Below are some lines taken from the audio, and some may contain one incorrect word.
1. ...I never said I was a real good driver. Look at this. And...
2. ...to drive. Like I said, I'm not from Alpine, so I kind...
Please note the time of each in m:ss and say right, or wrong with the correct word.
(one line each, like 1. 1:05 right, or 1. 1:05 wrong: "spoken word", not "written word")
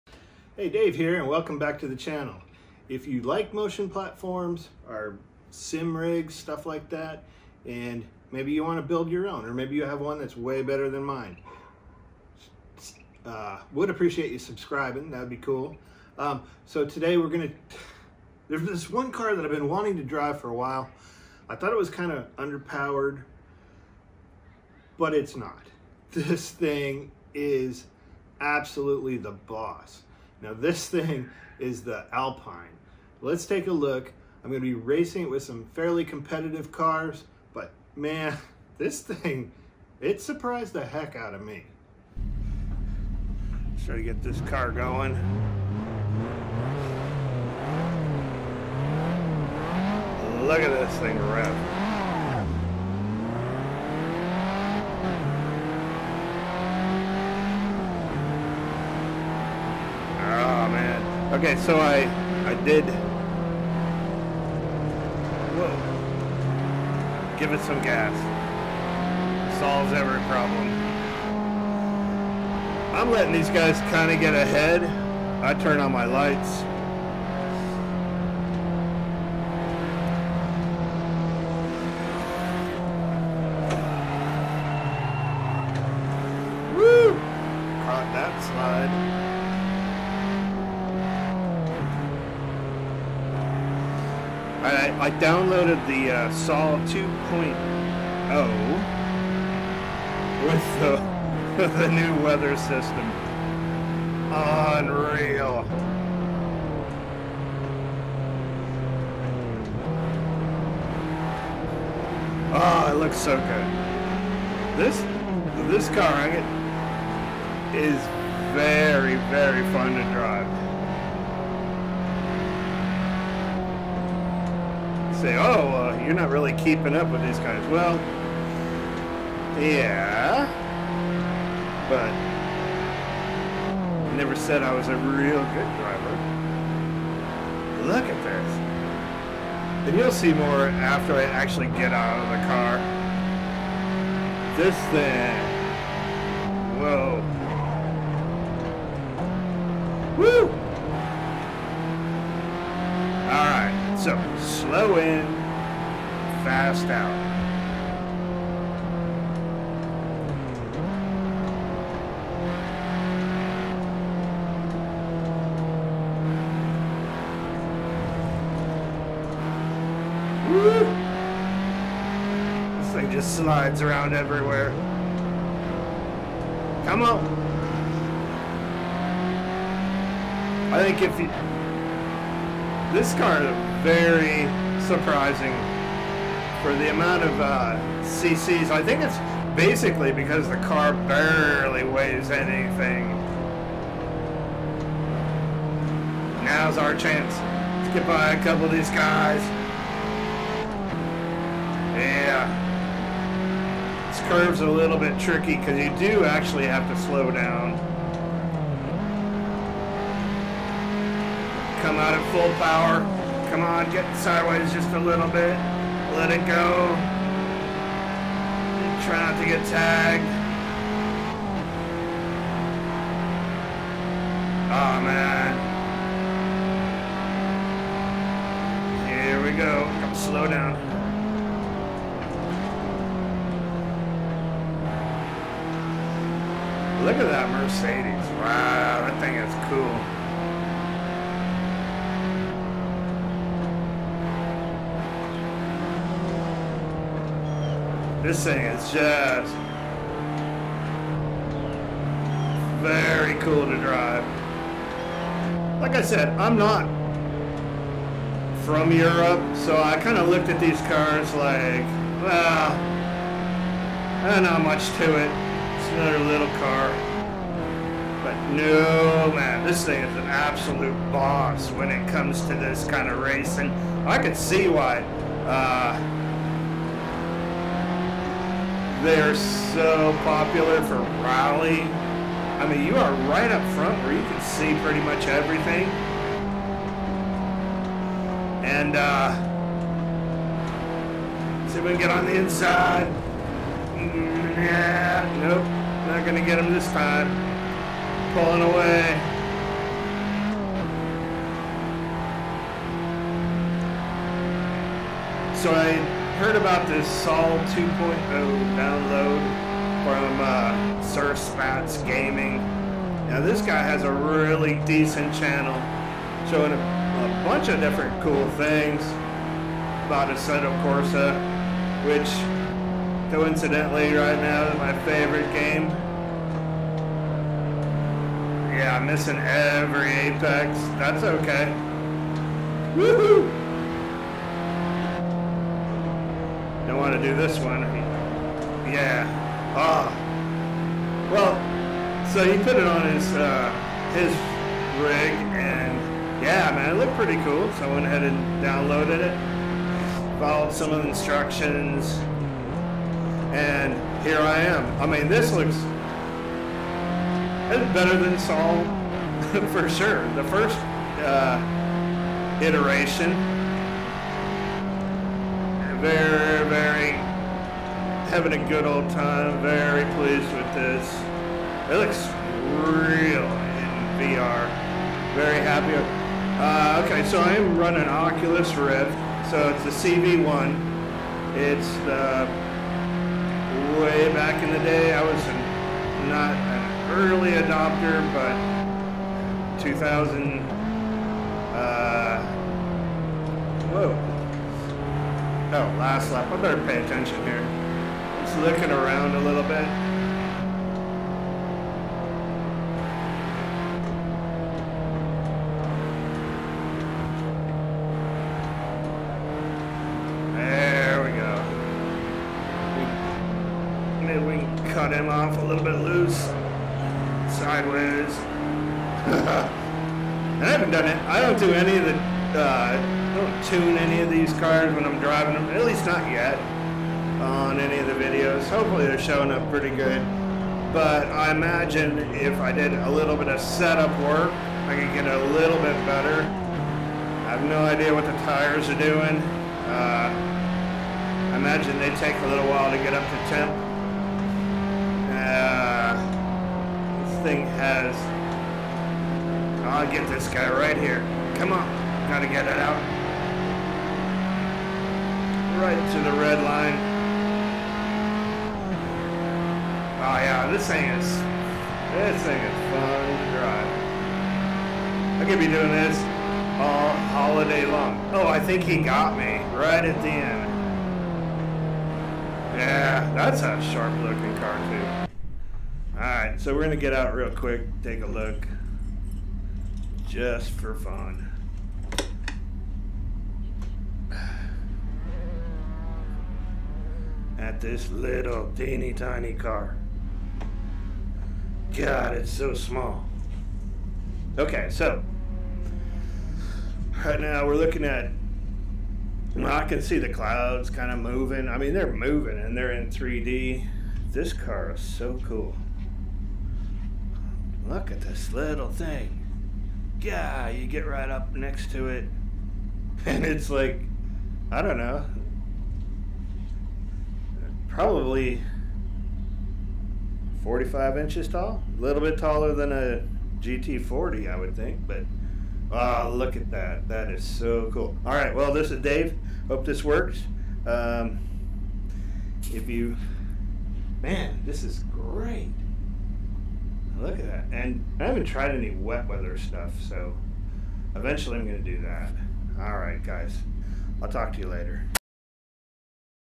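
1. 2:14 right
2. 4:13 wrong: "Europe", not "Alpine".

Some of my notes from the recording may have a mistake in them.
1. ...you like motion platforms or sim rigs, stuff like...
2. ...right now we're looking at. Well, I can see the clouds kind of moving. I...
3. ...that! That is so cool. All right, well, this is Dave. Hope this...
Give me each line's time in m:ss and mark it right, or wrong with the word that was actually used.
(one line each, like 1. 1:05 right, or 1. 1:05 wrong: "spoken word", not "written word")
1. 0:03 right
2. 8:17 right
3. 8:46 right.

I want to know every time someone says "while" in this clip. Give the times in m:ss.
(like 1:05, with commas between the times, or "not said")
0:20, 7:22.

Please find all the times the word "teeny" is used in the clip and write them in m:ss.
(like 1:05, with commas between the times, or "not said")
8:08.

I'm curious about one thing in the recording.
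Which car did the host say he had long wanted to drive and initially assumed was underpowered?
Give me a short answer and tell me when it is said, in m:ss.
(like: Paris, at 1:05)
Alpine, at 0:32.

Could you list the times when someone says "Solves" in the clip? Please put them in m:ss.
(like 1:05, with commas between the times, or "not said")
1:09.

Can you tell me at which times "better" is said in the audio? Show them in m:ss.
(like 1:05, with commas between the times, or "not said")
0:10, 5:57, 6:36, 7:16.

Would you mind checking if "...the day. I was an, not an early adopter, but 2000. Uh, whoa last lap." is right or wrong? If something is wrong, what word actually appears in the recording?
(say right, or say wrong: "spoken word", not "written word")
right.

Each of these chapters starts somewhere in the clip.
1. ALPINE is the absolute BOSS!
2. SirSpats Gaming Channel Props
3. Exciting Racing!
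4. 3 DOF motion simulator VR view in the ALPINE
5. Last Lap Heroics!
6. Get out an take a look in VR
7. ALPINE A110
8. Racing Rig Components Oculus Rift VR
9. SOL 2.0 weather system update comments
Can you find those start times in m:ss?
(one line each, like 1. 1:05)
1. 4:25
2. 5:05
3. 3:31
4. 0:43
5. 6:45
6. 7:57
7. 0:30
8. 6:13
9. 1:32.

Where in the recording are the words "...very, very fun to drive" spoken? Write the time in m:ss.
1:58.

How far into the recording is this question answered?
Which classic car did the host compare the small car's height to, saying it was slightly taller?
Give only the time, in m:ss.
8:43.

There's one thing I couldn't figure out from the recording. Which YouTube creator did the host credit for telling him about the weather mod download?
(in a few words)
Sir Spats Gaming.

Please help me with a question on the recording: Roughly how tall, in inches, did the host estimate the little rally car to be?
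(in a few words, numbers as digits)
45 inches.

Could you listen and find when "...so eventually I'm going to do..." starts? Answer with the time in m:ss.
9:00.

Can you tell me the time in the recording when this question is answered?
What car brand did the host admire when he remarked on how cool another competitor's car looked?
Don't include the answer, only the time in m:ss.
3:57.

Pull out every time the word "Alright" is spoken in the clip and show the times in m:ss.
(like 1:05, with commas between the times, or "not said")
2:33, 7:56.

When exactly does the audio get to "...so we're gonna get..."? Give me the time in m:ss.
7:56.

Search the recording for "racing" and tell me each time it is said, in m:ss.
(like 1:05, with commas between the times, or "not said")
0:34, 4:33.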